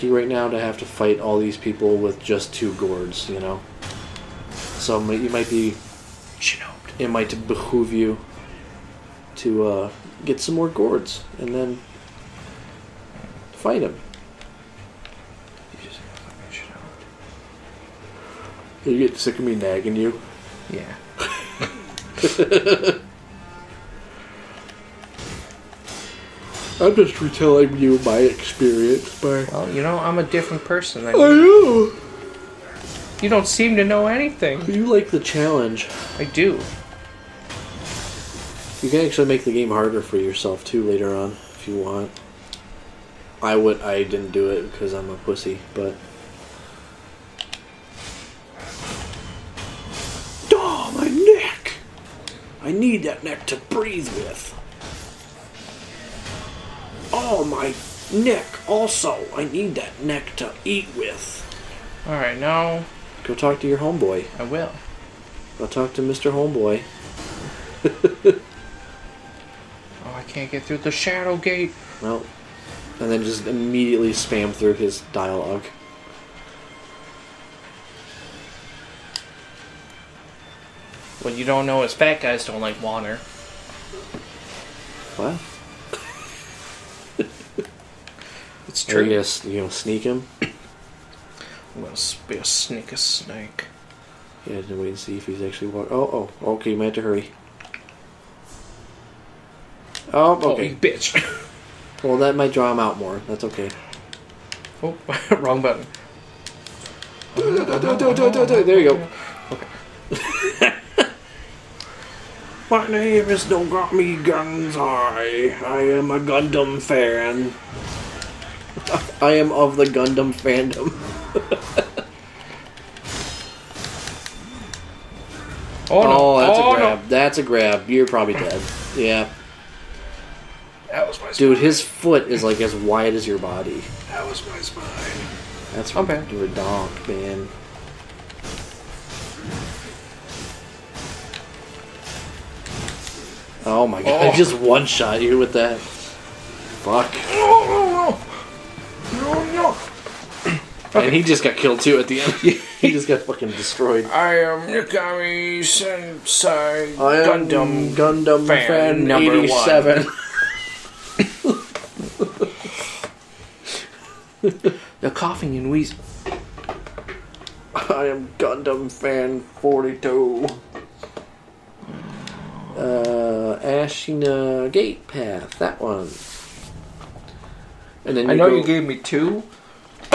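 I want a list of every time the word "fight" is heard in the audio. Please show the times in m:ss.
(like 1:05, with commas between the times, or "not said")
0:00, 0:13.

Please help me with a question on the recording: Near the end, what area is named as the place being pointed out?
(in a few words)
Ashina Gate Path.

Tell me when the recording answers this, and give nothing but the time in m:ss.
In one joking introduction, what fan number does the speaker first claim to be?
2:39.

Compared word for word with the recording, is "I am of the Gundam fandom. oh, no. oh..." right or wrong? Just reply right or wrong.
right.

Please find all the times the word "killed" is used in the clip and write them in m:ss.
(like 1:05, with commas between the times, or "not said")
2:31.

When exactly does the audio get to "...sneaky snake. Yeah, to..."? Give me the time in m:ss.
1:32.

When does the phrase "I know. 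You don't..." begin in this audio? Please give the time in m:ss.
0:31.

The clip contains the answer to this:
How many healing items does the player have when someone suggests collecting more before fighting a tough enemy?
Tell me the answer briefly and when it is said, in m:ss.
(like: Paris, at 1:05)
2, at 0:02.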